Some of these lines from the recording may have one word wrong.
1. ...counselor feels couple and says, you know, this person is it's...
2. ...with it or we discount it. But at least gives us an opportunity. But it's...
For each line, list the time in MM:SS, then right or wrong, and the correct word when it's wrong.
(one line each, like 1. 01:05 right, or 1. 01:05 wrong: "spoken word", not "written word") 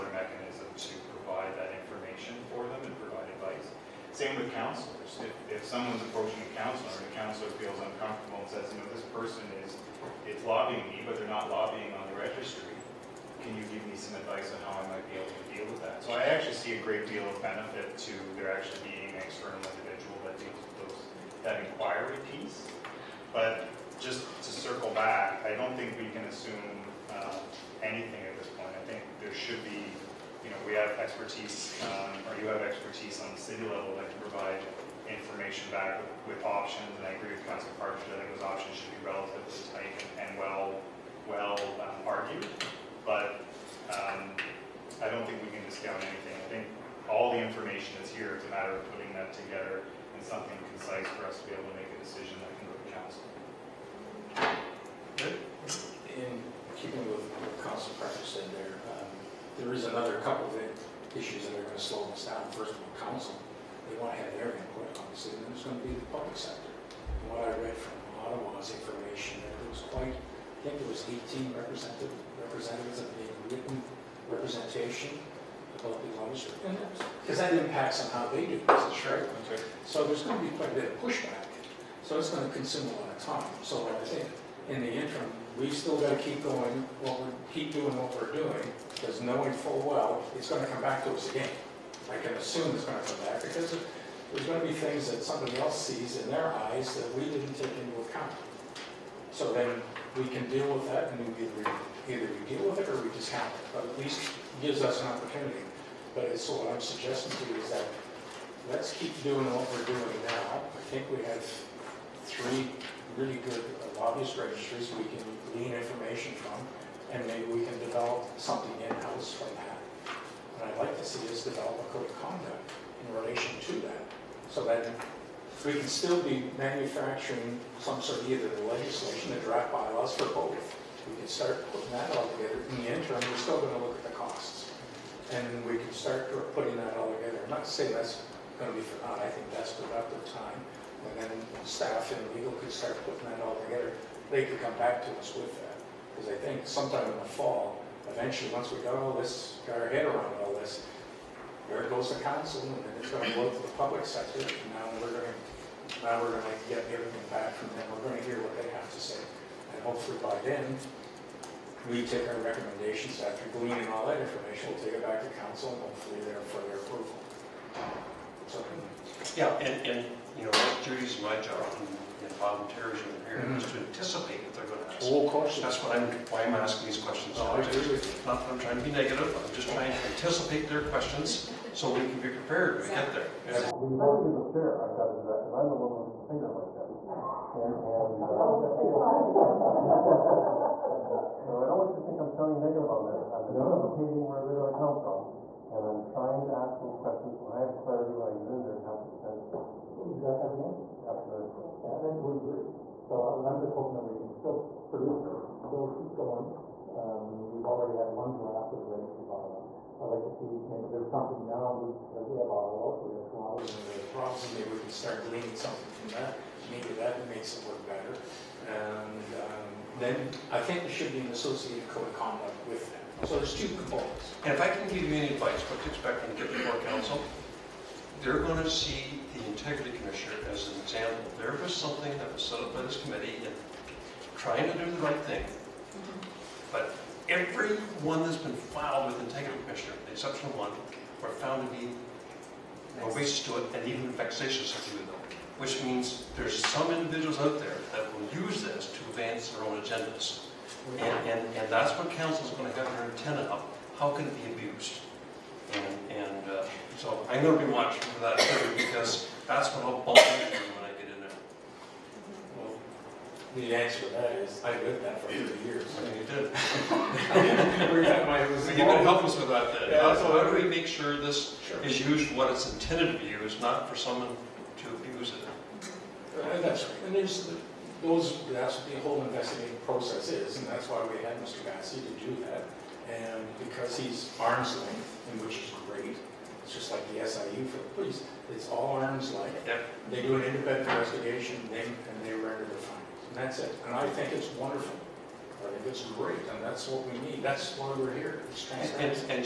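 1. 00:07 wrong: "uncomfortable", not "couple"
2. 01:42 right.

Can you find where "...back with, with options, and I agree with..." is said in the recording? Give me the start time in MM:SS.
00:35.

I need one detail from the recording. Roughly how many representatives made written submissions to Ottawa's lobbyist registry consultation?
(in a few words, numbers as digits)
18.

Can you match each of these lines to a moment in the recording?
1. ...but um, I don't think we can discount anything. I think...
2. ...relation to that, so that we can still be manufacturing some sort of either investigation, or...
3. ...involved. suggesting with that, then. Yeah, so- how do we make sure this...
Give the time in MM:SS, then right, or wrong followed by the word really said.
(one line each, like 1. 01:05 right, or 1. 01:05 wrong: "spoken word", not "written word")
1. 00:43 right
2. 02:03 wrong: "legislation", not "investigation"
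3. 04:28 wrong: "helping", not "suggesting".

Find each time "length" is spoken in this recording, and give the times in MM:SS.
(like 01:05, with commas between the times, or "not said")
04:44, 04:49.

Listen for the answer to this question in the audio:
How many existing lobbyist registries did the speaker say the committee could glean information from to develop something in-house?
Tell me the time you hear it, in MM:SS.
01:52.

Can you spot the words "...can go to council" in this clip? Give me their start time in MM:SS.
00:52.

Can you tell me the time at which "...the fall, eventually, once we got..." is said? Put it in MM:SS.
02:27.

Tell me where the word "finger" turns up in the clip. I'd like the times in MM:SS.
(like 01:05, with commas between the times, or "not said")
03:06.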